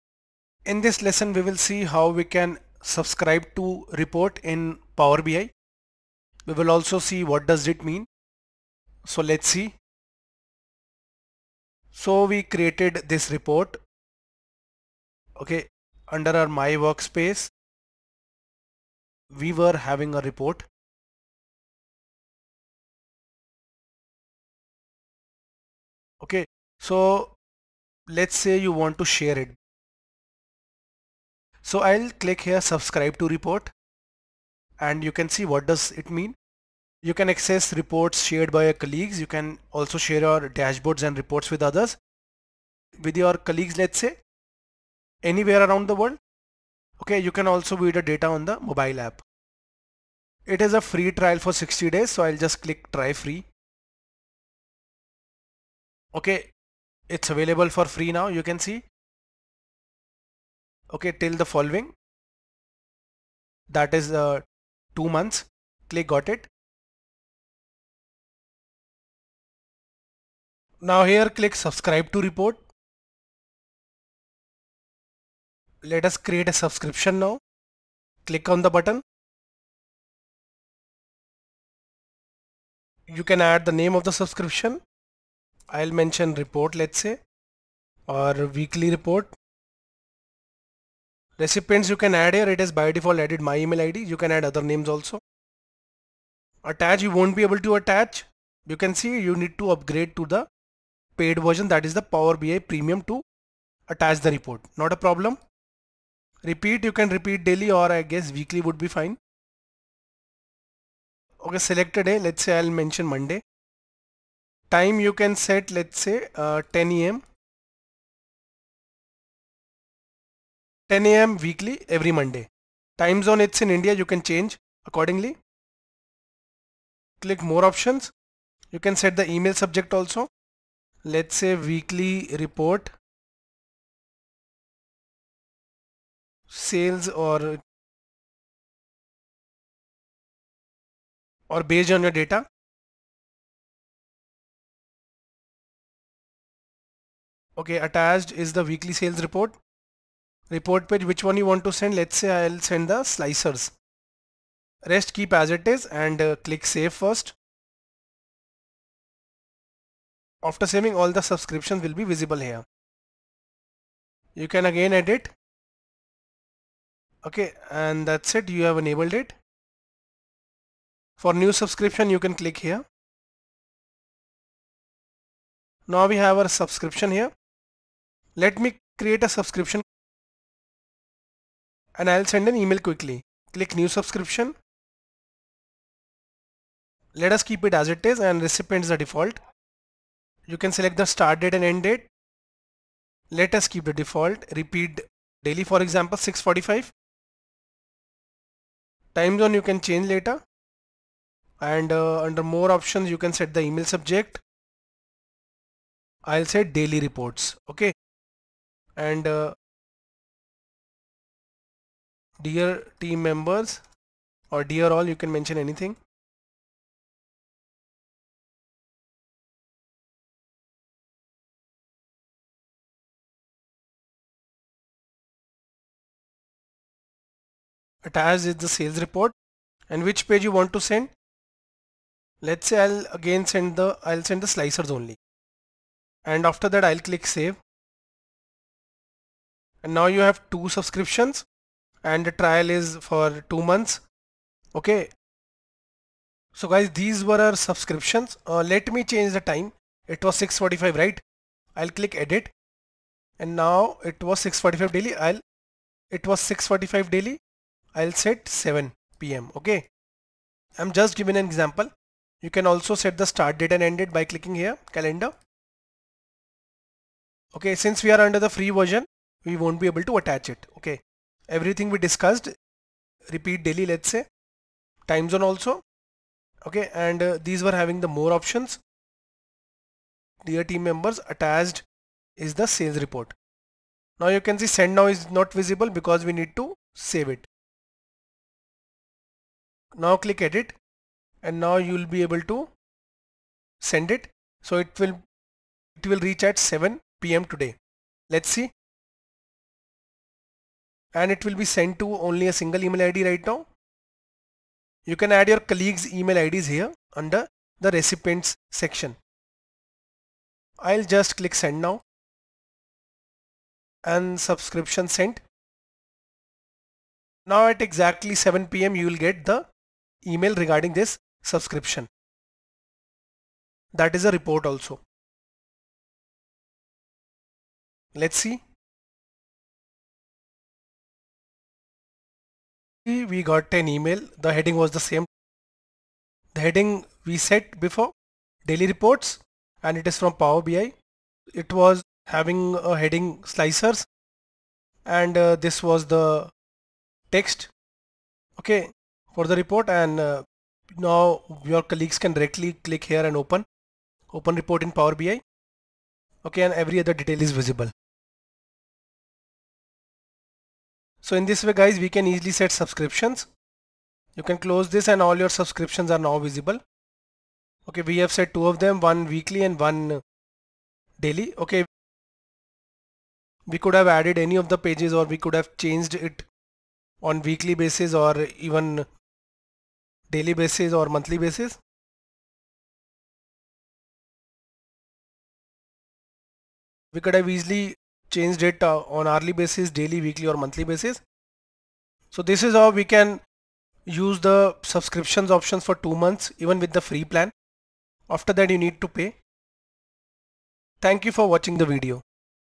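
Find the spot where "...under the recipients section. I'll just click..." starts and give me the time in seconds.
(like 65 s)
307 s.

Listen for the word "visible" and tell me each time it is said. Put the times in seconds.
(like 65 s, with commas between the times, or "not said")
162 s, 285 s, 357 s, 366 s.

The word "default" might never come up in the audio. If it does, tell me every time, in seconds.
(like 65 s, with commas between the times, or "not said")
92 s, 188 s, 193 s.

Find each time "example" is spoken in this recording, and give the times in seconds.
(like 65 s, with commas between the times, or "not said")
195 s, 261 s.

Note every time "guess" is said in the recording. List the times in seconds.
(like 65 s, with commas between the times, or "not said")
108 s.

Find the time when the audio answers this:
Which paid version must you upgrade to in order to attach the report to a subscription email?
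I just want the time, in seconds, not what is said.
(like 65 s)
102 s.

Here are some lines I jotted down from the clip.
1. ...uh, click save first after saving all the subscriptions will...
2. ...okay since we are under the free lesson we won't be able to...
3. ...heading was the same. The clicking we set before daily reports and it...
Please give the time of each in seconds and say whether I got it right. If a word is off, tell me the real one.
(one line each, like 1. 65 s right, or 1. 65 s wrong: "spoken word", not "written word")
1. 156 s right
2. 267 s wrong: "version", not "lesson"
3. 334 s wrong: "heading", not "clicking".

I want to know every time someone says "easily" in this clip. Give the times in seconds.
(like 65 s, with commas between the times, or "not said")
362 s, 387 s.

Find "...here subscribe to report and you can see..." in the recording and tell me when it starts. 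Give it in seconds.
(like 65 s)
32 s.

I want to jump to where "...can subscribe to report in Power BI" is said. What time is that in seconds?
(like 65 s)
2 s.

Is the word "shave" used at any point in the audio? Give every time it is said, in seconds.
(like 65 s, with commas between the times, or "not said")
not said.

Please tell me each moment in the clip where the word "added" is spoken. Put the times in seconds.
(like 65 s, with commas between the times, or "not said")
93 s, 374 s.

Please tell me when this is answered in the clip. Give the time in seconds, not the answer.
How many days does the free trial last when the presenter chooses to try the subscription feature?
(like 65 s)
51 s.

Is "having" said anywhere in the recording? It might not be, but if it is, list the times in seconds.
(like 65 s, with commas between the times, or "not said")
19 s, 277 s, 342 s.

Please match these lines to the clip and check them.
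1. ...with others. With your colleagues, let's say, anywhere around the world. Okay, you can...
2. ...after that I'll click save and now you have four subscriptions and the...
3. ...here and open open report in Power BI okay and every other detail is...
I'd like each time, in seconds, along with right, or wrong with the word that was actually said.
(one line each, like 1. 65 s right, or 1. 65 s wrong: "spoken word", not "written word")
1. 41 s right
2. 236 s wrong: "two", not "four"
3. 353 s right.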